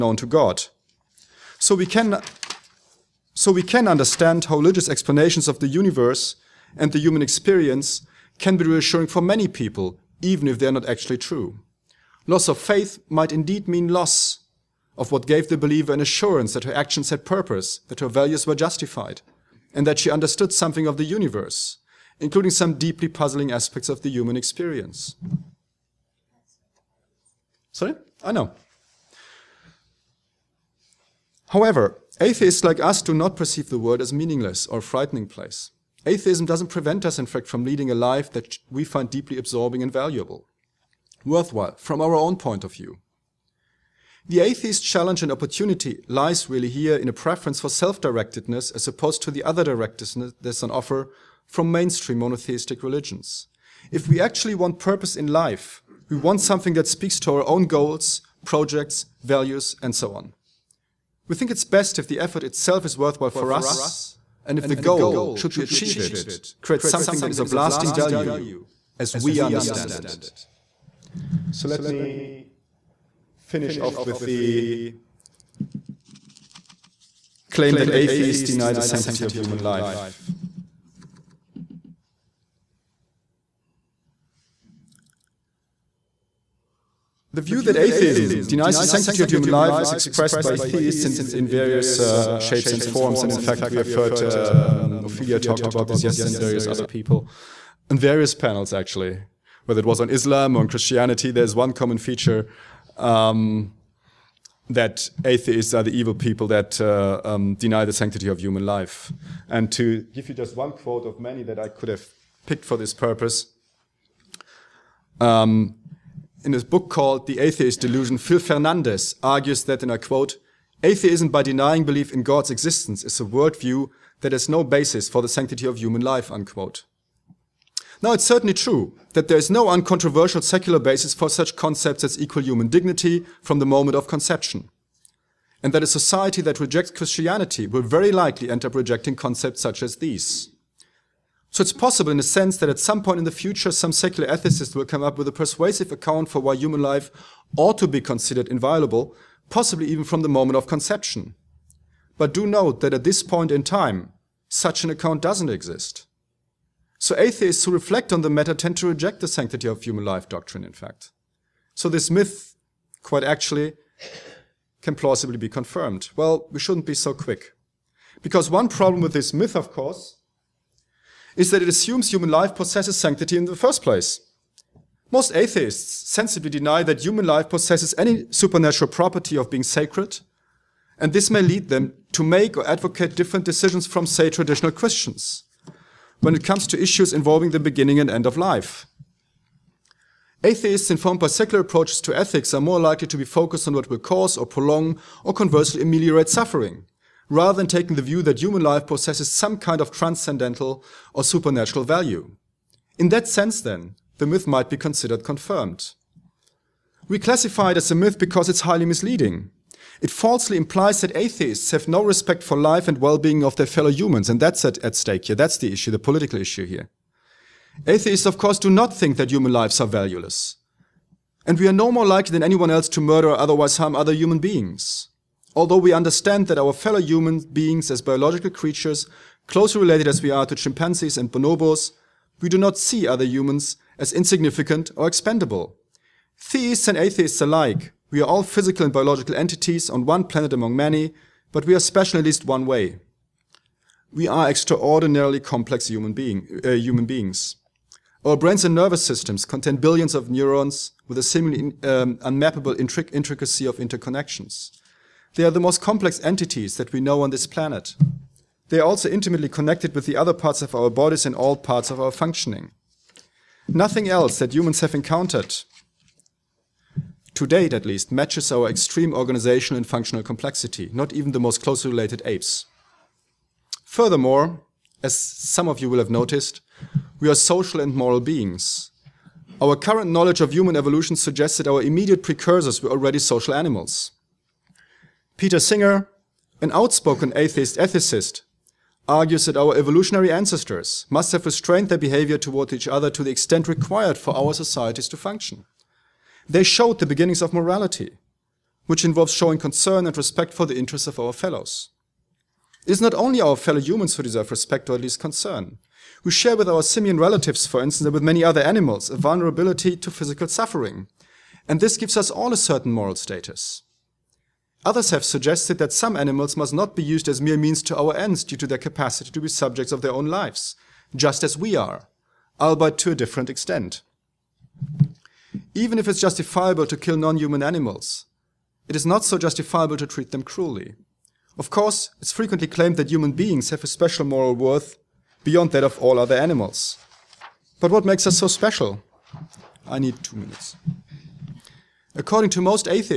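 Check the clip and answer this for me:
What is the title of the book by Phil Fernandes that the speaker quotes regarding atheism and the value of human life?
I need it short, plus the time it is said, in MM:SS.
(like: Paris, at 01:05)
The Atheist Delusion, at 01:57.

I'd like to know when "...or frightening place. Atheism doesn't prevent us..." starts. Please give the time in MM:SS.
00:34.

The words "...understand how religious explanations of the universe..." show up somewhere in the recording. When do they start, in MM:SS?
00:03.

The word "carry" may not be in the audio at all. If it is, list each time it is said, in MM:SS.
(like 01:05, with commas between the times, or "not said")
not said.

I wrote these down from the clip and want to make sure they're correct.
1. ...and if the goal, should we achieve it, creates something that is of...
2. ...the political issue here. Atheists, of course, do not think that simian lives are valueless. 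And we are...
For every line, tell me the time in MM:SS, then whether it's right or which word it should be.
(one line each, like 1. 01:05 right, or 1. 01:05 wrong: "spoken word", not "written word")
1. 01:04 right
2. 03:35 wrong: "human", not "simian".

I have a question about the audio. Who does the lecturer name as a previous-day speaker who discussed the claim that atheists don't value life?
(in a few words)
Ophelia.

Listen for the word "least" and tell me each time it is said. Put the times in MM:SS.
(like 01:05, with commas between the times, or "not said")
04:02, 04:27, 05:05.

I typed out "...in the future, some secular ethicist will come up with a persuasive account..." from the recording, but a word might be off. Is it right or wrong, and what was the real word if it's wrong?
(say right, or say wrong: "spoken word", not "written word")
right.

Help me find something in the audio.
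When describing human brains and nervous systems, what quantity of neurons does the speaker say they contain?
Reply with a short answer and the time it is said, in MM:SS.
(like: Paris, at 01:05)
billions, at 04:09.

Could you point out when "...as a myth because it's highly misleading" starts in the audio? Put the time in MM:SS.
03:27.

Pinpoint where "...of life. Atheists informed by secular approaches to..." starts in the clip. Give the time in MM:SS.
03:08.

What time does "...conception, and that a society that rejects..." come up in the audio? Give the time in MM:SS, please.
02:14.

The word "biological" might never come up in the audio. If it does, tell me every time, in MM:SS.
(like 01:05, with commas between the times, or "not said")
03:48, 03:58.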